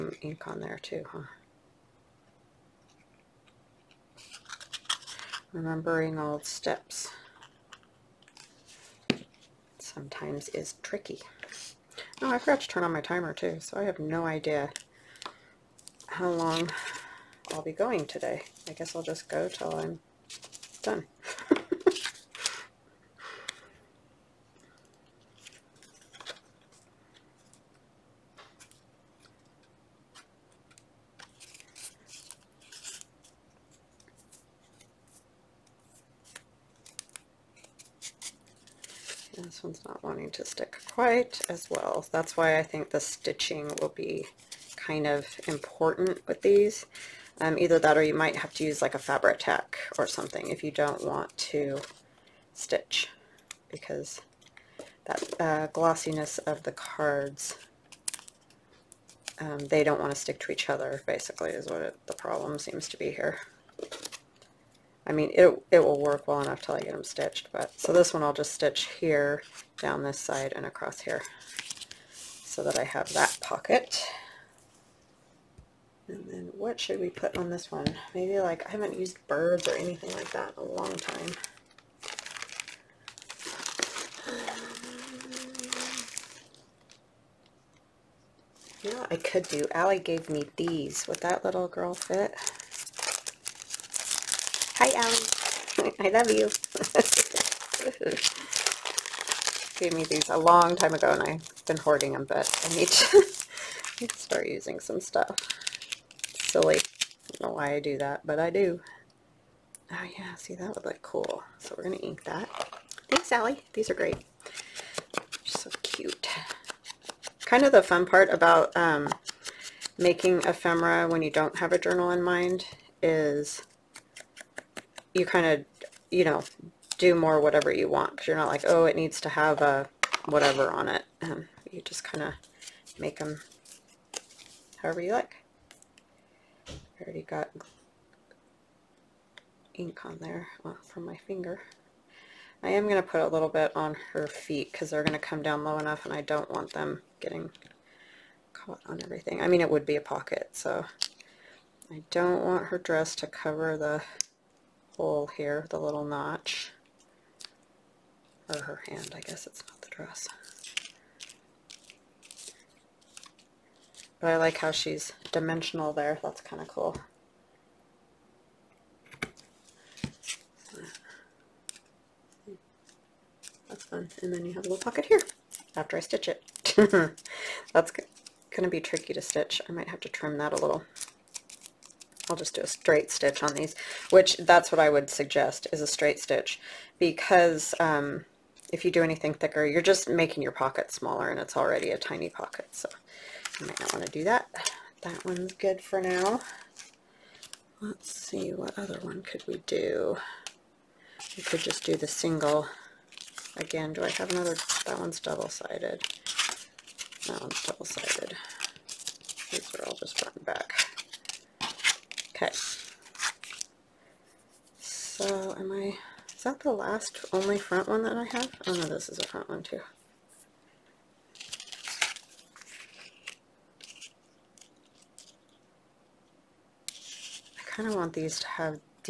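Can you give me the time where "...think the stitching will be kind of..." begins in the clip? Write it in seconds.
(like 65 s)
42 s.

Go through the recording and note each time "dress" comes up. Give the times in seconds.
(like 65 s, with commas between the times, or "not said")
152 s, 159 s.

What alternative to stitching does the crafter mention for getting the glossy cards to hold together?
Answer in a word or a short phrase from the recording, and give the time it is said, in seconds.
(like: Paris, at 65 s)
fabric tack, at 48 s.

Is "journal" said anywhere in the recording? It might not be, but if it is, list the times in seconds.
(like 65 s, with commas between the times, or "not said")
121 s.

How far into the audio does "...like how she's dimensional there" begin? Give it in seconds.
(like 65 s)
164 s.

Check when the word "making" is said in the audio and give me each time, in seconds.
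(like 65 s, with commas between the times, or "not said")
119 s, 190 s.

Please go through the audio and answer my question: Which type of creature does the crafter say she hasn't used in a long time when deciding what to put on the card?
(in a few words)
birds.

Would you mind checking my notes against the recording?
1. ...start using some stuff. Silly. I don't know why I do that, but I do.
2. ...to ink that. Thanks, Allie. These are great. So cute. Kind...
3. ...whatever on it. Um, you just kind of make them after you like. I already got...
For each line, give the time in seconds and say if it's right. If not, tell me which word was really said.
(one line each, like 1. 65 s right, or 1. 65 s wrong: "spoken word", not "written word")
1. 104 s right
2. 111 s right
3. 130 s wrong: "however", not "after".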